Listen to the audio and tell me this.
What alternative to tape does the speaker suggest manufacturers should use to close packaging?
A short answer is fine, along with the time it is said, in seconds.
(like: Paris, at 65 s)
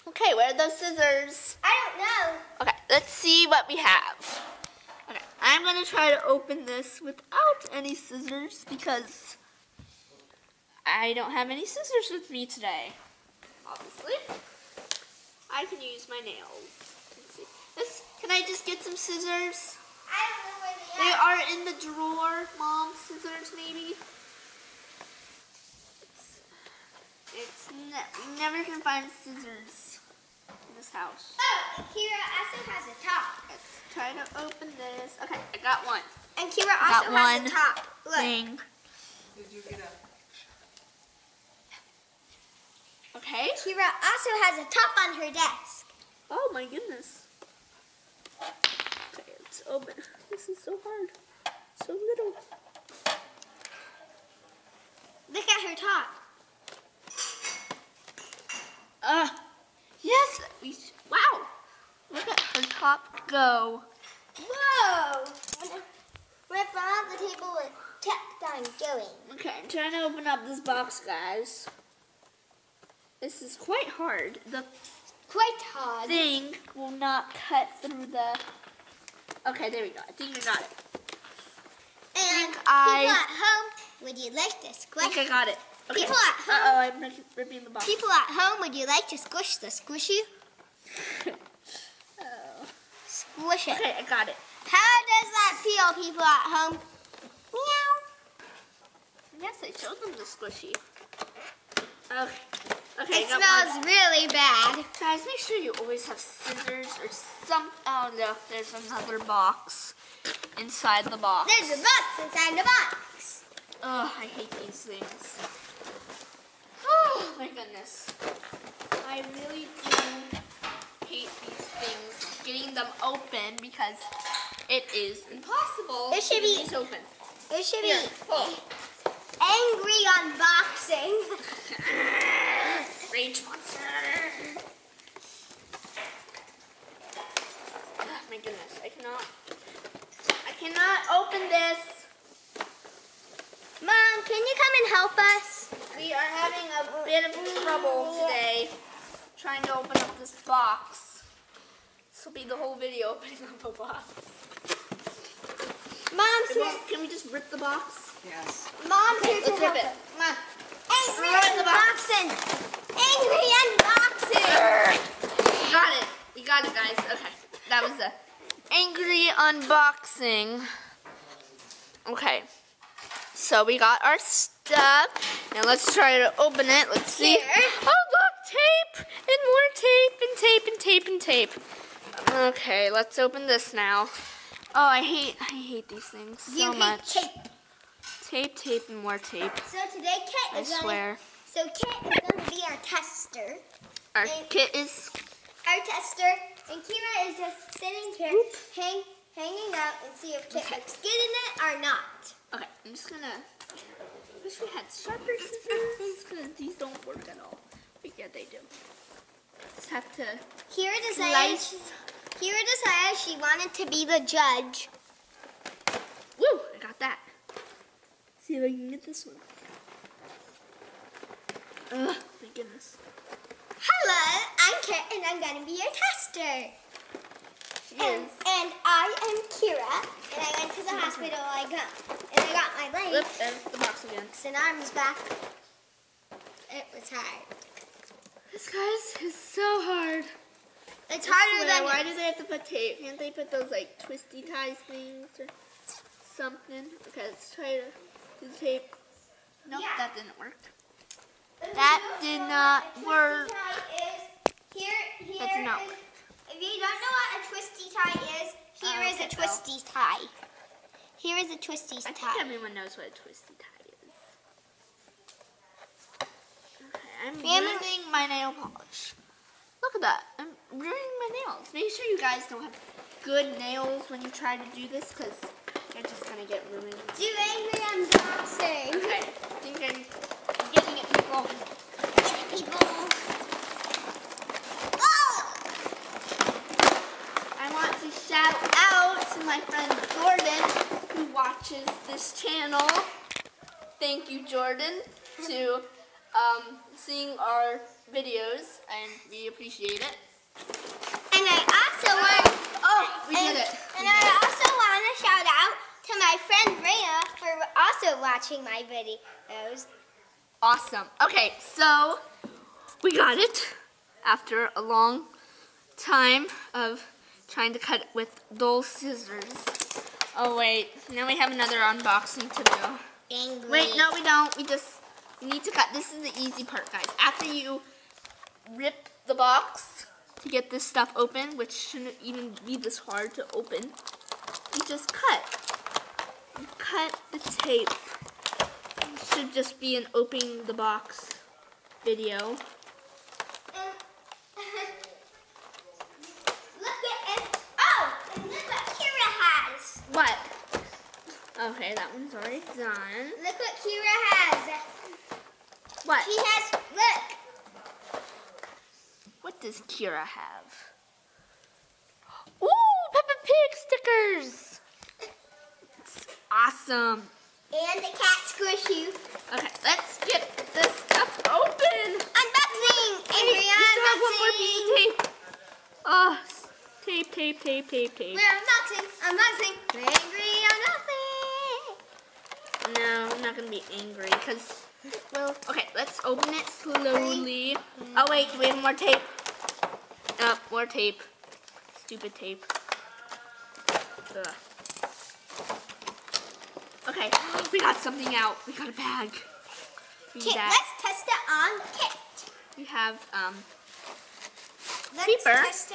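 twisty ties, at 243 s.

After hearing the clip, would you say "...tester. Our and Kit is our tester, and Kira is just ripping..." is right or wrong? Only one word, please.
wrong.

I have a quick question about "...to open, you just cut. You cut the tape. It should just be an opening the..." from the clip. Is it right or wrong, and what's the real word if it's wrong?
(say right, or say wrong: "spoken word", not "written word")
right.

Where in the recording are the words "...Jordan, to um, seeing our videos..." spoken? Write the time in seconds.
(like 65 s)
294 s.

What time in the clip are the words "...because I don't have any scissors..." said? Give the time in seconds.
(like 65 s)
8 s.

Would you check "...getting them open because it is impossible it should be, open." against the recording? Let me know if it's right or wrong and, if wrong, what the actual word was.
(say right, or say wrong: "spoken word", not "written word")
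right.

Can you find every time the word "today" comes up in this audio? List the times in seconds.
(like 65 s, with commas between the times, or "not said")
12 s, 148 s, 189 s.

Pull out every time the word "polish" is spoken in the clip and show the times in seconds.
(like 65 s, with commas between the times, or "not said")
268 s.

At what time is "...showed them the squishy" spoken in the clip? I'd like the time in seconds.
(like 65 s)
99 s.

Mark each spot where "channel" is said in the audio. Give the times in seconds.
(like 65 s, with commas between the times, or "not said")
292 s.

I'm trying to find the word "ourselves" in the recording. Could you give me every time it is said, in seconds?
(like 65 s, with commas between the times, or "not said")
not said.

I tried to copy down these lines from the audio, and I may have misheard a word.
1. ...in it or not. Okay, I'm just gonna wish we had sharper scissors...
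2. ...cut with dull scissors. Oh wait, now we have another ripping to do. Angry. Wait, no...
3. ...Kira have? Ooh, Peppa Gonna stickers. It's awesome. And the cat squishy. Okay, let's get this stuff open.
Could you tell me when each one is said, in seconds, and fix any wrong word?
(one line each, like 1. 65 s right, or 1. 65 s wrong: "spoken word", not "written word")
1. 201 s right
2. 317 s wrong: "unboxing", not "ripping"
3. 359 s wrong: "Pig", not "Gonna".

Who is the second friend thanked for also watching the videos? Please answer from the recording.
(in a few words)
Rhea.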